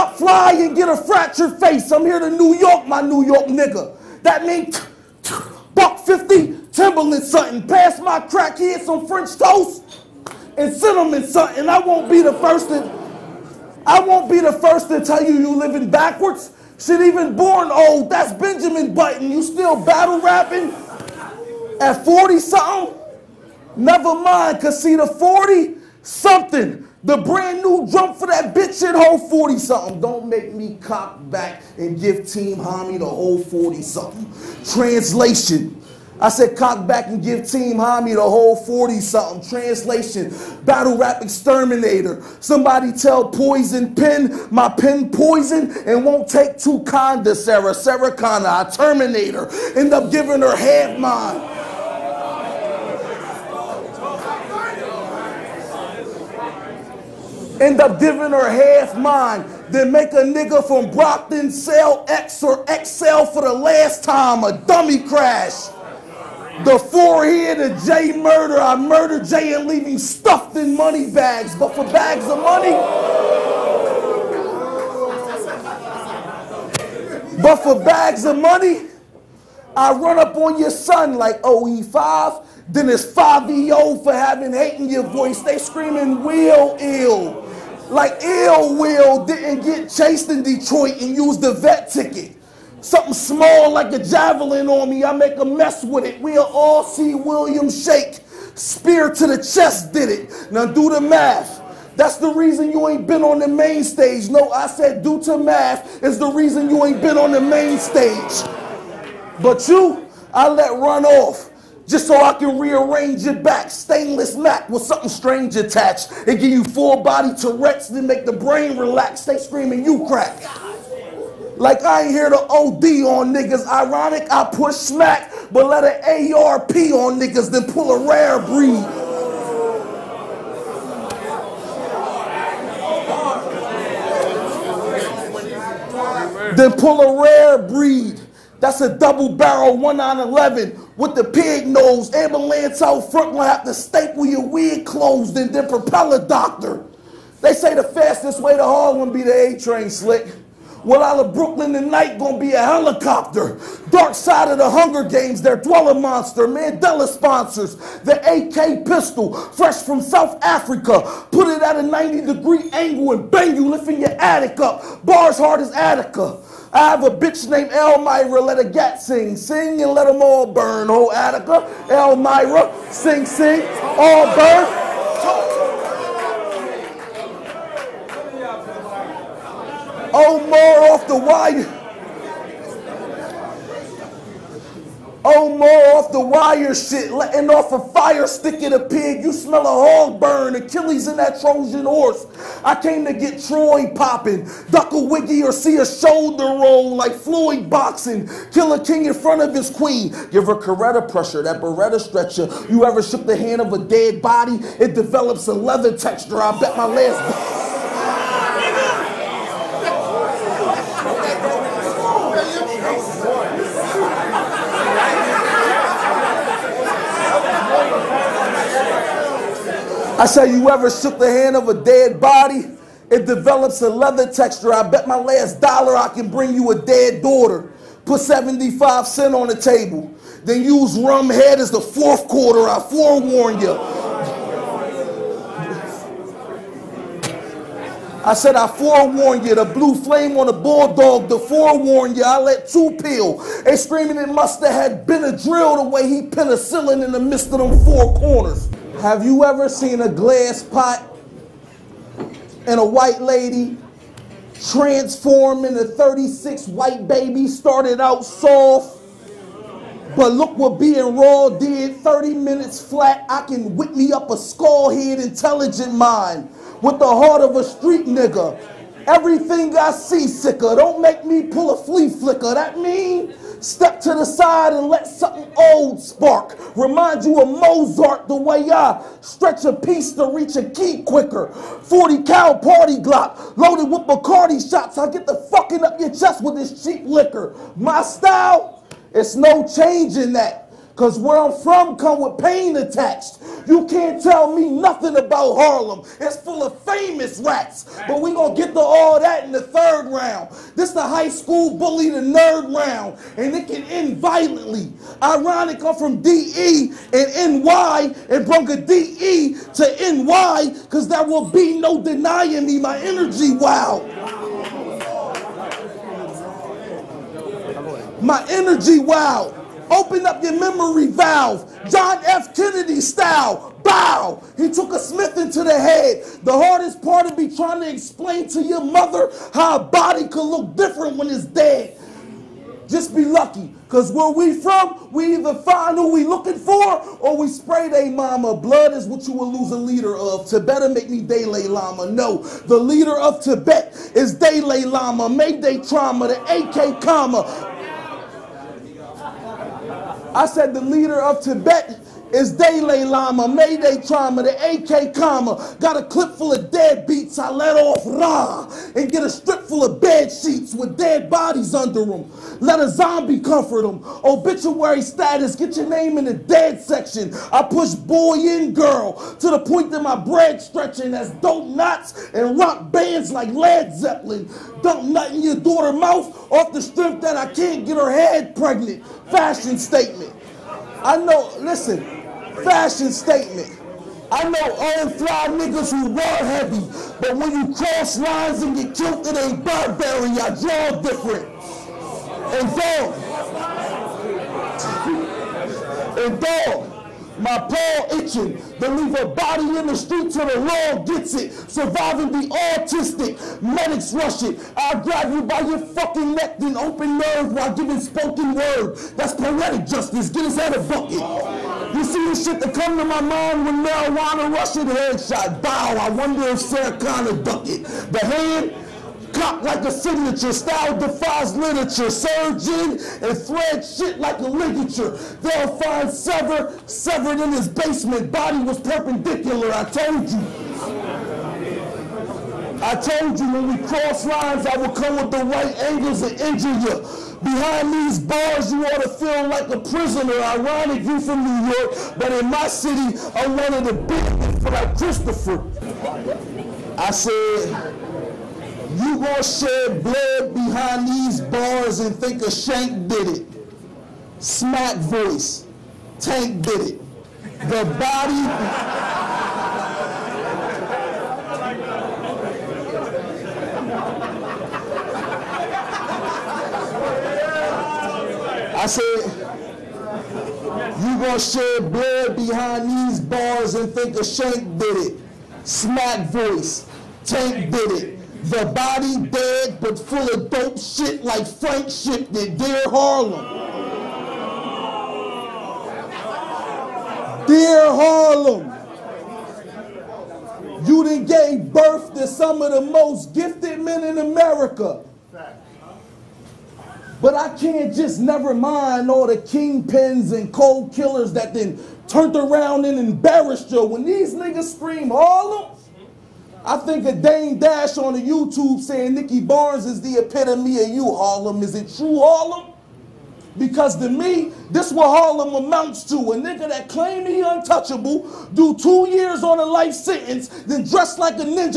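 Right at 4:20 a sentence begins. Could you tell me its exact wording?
But look what being raw did 30 minutes flat.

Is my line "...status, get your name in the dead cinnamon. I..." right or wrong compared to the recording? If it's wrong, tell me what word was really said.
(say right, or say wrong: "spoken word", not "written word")
wrong: "section", not "cinnamon".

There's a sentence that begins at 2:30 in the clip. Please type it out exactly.
Well, out of Brooklyn tonight, gonna be a helicopter.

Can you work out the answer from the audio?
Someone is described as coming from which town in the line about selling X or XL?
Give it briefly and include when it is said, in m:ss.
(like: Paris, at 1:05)
Brockton, at 1:00.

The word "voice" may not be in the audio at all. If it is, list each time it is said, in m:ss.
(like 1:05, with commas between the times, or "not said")
1:25, 7:34, 7:56.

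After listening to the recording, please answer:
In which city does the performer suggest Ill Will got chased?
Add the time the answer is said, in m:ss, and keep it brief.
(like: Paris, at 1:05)
Detroit, at 1:30.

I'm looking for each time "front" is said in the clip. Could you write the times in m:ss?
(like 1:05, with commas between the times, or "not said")
2:23, 3:19.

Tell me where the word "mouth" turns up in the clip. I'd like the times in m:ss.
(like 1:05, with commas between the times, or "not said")
6:15.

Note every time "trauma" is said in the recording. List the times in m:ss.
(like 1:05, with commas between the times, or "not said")
5:45, 5:54.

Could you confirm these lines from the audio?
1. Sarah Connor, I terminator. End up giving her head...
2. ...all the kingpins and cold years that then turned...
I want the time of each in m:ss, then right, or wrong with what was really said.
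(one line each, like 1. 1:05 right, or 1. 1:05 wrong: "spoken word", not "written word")
1. 0:47 right
2. 8:19 wrong: "killers", not "years".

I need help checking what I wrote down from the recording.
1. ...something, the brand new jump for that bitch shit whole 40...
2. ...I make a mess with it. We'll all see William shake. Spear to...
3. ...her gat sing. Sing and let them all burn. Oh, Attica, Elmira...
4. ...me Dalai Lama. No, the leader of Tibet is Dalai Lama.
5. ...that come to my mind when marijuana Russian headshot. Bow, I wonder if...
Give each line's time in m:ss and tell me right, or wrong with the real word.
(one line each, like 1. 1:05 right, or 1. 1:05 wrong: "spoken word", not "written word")
1. 0:26 right
2. 1:35 right
3. 2:48 right
4. 5:41 right
5. 6:52 right.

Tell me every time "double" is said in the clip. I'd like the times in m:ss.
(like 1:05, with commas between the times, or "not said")
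2:18.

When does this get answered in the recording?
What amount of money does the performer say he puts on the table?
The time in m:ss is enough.
3:48.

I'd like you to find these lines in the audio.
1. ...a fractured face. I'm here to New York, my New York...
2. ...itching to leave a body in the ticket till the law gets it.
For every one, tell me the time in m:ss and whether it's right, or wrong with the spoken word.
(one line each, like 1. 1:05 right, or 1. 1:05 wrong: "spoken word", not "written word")
1. 0:00 right
2. 6:38 wrong: "street", not "ticket".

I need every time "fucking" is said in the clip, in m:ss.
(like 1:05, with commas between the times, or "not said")
4:45, 6:45.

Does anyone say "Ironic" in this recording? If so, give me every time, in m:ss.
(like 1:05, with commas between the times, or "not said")
2:03, 5:05, 7:20.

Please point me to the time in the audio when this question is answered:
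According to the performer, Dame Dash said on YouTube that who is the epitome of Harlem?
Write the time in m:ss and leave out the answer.
8:29.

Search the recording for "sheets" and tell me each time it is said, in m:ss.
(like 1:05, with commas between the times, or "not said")
6:00.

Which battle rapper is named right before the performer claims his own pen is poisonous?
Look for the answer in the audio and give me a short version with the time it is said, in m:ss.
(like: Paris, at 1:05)
Poison Pen, at 0:43.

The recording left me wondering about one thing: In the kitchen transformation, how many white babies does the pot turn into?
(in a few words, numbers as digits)
36.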